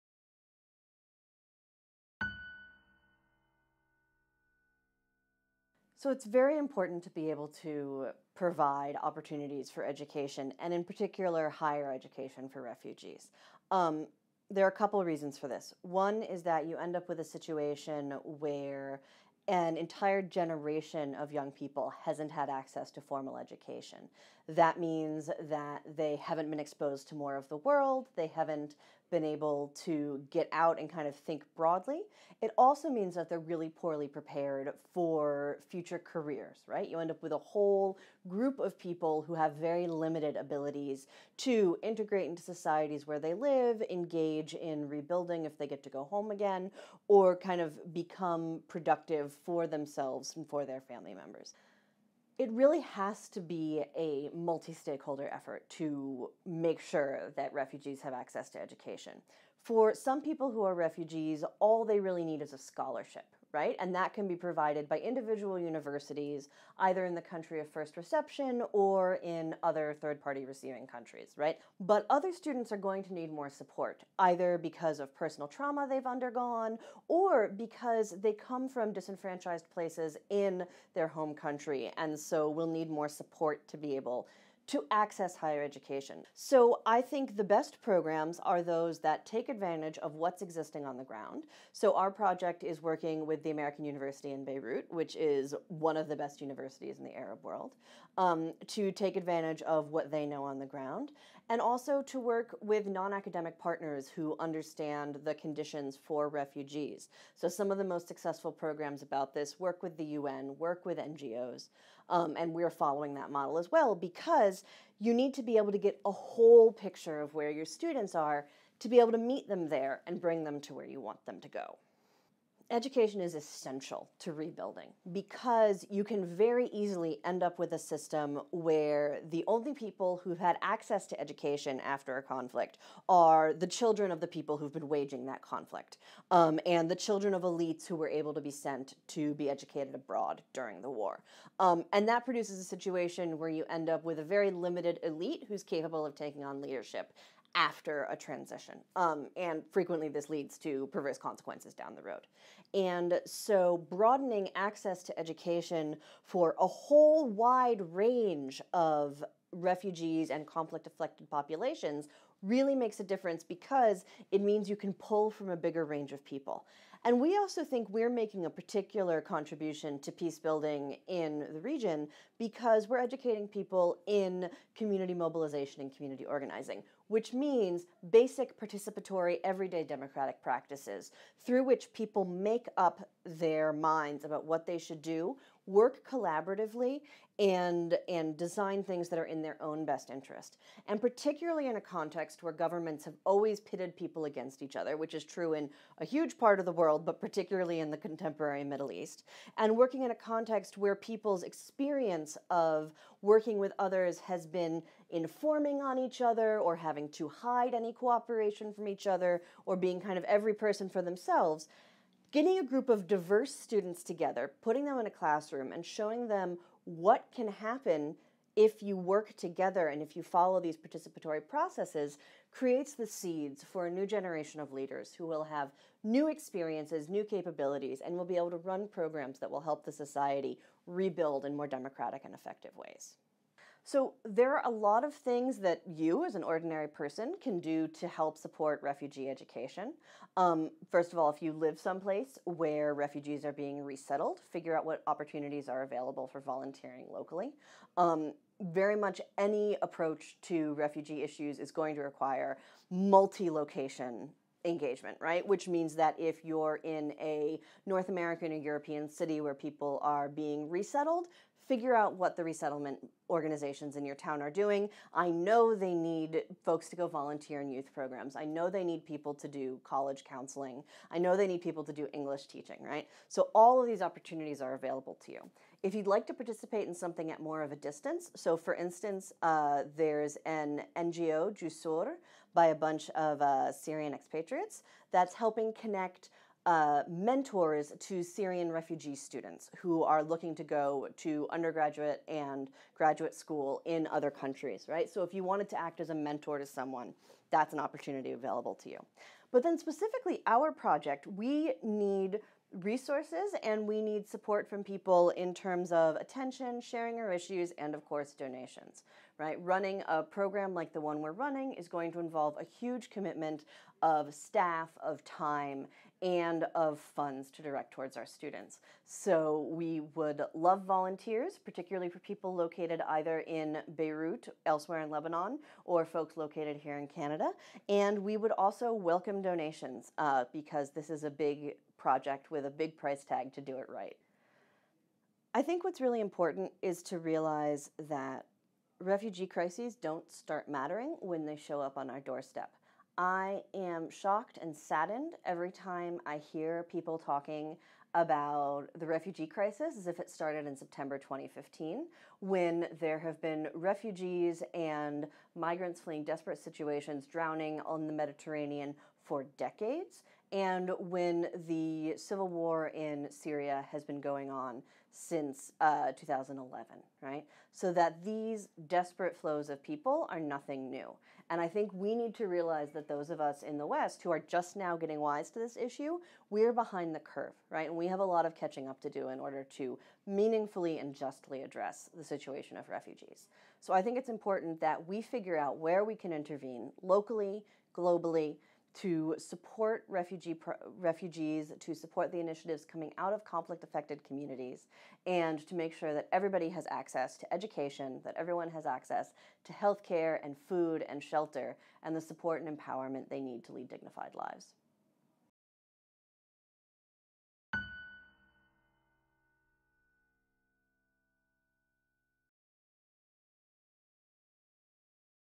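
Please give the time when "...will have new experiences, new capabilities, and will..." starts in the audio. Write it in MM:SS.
03:45.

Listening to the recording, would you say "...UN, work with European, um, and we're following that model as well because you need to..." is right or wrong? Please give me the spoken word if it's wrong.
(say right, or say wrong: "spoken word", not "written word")
wrong: "NGOs", not "European".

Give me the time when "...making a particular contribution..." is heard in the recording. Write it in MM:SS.
02:48.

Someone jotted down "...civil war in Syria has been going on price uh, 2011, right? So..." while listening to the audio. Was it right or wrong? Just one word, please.
wrong.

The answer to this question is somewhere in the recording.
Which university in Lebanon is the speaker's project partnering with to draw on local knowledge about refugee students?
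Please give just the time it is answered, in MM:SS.
01:33.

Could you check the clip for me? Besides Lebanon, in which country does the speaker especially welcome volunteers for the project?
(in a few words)
Canada.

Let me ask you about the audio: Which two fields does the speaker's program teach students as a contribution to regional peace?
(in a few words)
Community mobilization and community organizing.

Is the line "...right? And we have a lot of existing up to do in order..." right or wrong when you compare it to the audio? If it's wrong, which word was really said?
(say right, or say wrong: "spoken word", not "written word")
wrong: "catching", not "existing".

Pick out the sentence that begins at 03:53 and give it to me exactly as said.
So there are a lot of things that you, as an ordinary person, can do to help support refugee education.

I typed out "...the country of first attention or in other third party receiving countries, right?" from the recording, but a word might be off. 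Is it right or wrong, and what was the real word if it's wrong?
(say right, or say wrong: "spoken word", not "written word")
wrong: "reception", not "attention".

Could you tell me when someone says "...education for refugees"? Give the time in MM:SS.
00:11.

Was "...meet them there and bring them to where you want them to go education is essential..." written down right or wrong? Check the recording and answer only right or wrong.
right.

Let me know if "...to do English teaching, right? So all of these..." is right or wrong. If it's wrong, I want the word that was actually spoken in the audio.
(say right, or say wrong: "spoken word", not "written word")
right.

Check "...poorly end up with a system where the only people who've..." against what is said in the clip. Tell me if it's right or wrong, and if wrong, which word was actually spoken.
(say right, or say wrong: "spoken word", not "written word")
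wrong: "easily", not "poorly".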